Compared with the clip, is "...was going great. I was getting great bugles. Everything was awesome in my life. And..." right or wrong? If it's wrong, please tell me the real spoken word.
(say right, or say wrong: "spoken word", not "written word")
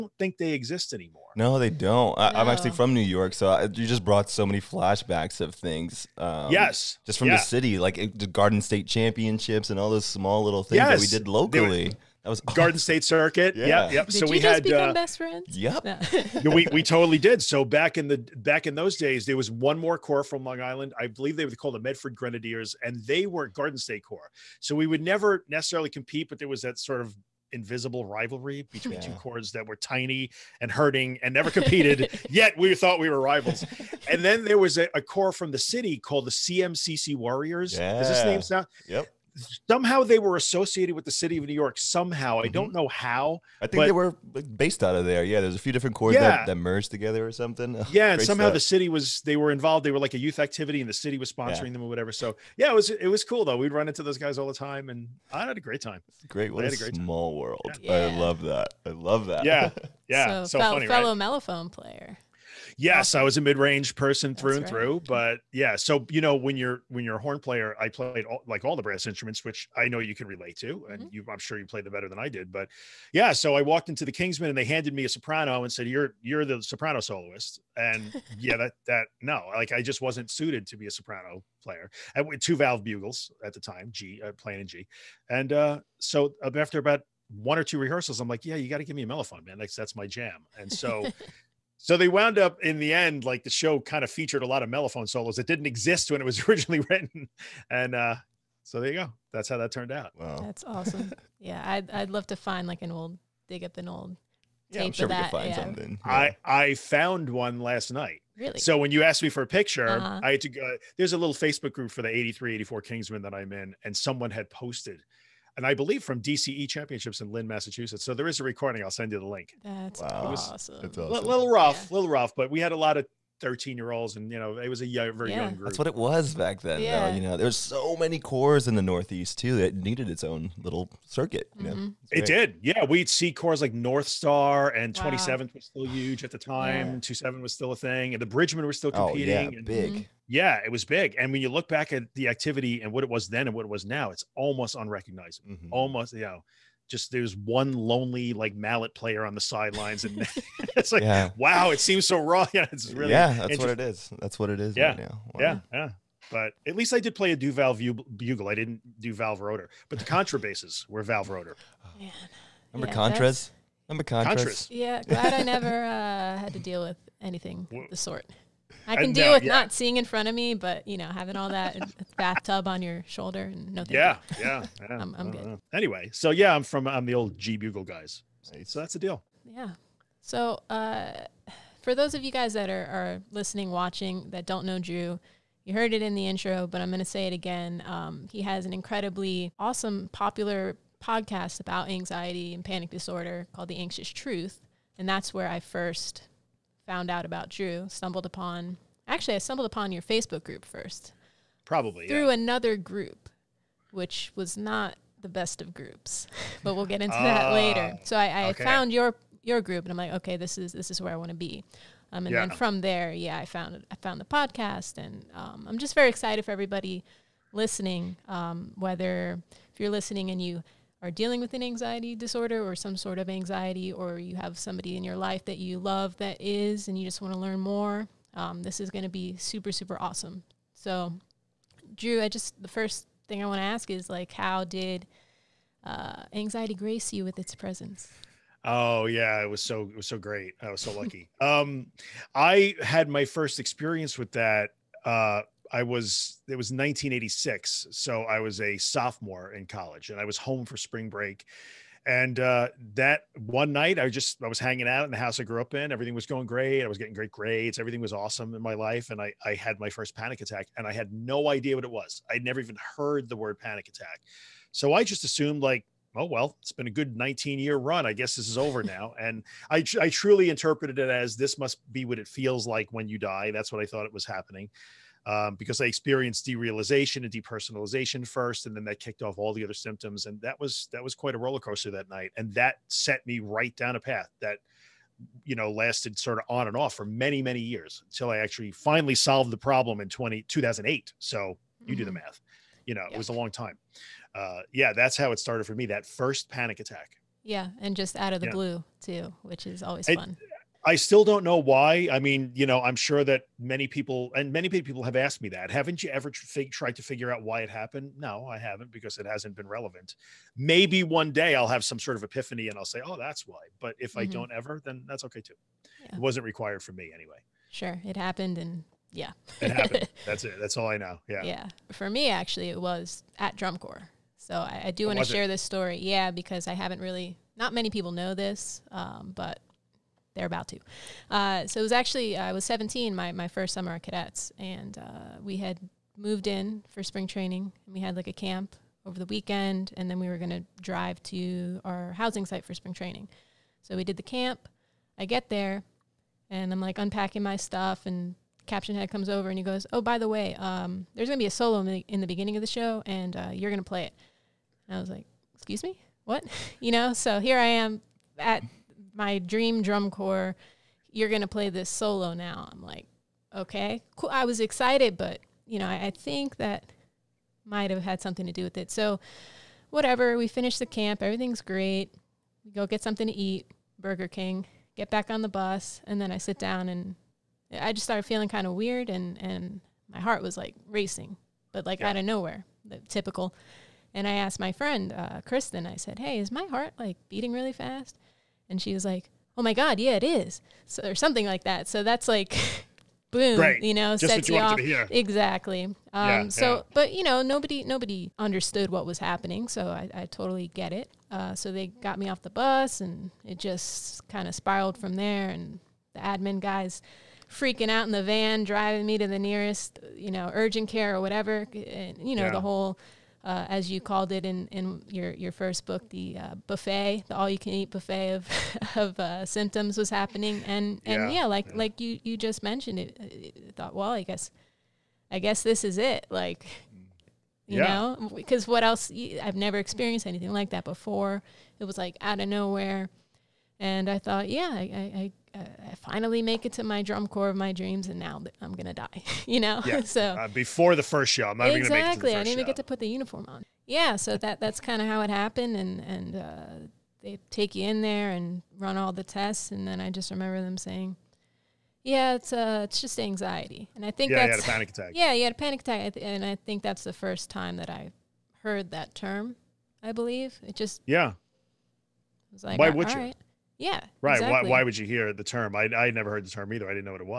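wrong: "grades", not "bugles".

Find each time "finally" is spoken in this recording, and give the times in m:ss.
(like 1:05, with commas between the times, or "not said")
4:48, 7:15.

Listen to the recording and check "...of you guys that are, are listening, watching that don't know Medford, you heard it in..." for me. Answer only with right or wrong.
wrong.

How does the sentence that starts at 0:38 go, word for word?
is this name sound yep somehow they were associated with the city of New York.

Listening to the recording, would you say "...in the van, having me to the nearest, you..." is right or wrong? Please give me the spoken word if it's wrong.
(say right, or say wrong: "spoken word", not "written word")
wrong: "driving", not "having".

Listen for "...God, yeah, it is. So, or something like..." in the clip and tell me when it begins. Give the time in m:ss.
6:29.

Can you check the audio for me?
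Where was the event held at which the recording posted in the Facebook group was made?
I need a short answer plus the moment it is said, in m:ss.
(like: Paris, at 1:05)
Lynn, Massachusetts, at 1:57.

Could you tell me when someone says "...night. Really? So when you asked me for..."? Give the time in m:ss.
1:47.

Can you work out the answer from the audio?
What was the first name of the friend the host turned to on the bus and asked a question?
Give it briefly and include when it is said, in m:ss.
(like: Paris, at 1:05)
Kristen, at 6:25.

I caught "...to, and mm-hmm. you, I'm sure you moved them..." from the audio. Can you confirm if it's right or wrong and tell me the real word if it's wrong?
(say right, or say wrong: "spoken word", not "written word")
wrong: "played", not "moved".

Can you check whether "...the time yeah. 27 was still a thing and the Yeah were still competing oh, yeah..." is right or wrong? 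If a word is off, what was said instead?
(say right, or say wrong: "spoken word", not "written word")
wrong: "Bridgemen", not "Yeah".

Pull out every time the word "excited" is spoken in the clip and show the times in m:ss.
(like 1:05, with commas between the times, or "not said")
3:36, 6:04.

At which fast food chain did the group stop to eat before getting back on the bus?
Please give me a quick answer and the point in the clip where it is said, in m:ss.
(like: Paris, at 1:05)
Burger King, at 6:13.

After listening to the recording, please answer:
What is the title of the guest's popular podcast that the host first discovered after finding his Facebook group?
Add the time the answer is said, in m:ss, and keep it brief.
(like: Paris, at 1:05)
The Anxious Truth, at 3:13.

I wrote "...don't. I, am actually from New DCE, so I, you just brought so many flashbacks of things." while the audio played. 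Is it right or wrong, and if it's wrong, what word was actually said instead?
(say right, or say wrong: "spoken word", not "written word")
wrong: "York", not "DCE".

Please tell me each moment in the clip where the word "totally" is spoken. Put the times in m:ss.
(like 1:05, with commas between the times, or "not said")
0:16, 6:40.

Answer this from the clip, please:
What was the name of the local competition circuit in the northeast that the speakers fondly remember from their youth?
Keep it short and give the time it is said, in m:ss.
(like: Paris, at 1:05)
Garden State Circuit, at 0:12.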